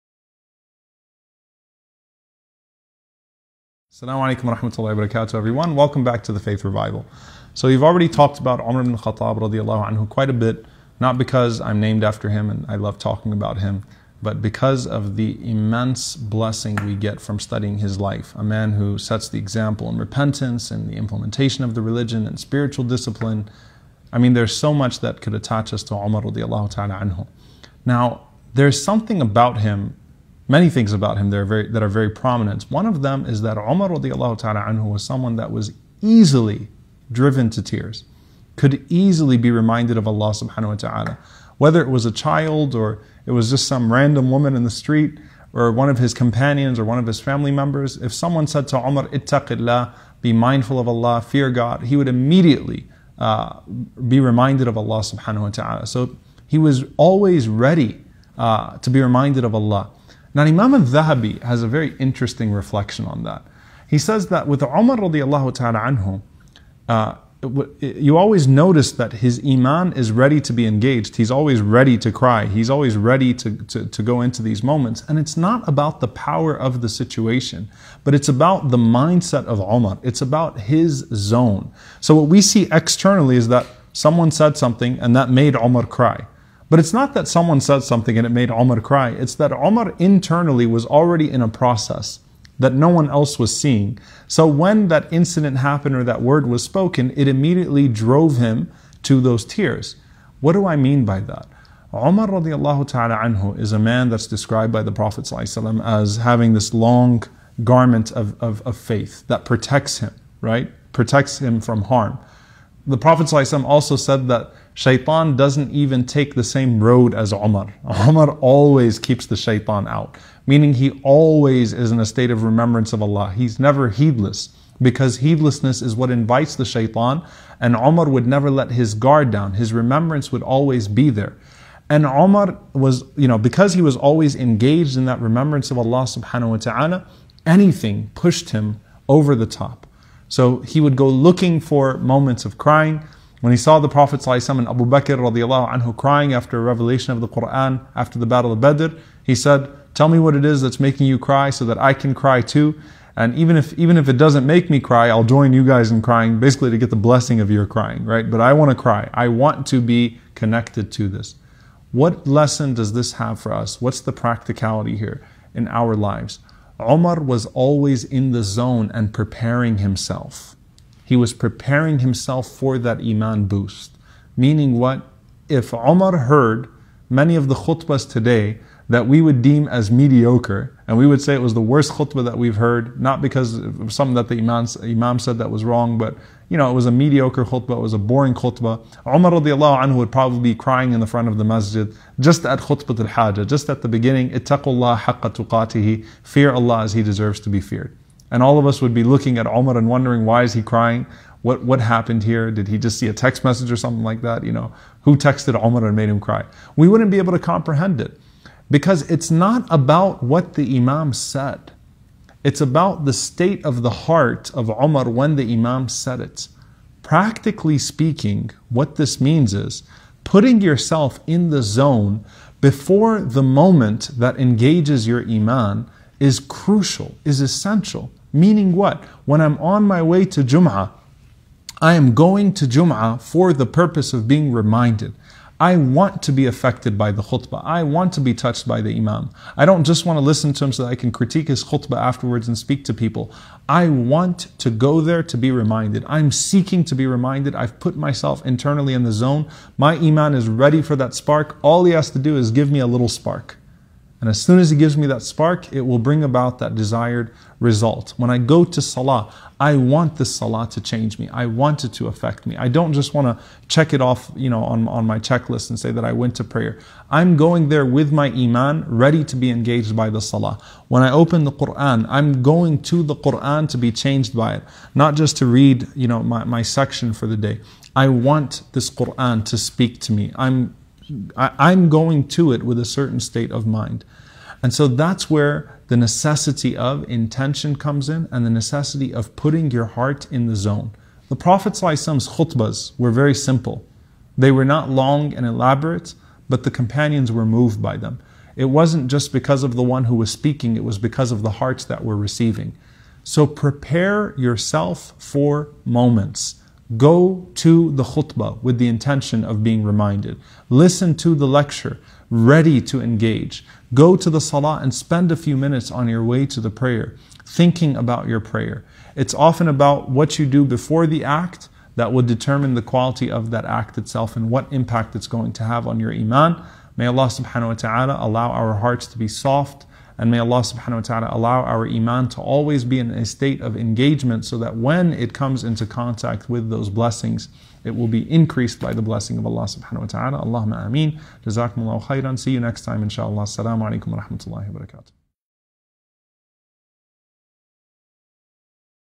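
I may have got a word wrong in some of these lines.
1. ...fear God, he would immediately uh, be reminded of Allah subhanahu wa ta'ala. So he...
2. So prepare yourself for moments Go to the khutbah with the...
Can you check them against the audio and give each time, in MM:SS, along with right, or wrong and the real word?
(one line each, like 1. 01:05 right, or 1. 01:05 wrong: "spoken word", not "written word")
1. 00:51 right
2. 05:03 right.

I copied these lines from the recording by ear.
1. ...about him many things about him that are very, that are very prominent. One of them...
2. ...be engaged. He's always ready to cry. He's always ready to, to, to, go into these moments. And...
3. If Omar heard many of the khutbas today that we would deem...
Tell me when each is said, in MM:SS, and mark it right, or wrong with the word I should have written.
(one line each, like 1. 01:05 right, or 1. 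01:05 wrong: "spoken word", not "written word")
1. 00:29 right
2. 01:10 right
3. 02:55 right.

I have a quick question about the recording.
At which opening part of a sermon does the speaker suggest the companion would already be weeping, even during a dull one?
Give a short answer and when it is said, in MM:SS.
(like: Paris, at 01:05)
Khutbah al-Hajjah, at 03:12.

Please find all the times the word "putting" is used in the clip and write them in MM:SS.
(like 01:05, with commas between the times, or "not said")
03:40, 04:49.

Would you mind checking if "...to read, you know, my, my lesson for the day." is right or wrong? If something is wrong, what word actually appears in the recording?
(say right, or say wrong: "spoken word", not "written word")
wrong: "section", not "lesson".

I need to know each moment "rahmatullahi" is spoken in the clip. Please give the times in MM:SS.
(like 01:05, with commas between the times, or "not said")
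00:04, 05:44.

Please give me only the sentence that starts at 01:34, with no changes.
So when that incident happened or that word was spoken, it immediately drove him to those tears.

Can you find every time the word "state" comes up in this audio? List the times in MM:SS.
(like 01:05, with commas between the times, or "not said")
02:02, 03:33, 04:43, 05:33.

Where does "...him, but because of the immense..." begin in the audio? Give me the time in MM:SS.
00:13.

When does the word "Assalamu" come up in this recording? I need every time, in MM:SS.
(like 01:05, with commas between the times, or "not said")
00:03, 05:43.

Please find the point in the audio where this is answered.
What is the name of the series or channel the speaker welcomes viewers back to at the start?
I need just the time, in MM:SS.
00:06.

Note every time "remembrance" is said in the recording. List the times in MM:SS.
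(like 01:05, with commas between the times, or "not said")
02:02, 02:09, 02:15.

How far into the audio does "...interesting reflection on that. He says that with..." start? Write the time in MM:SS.
01:01.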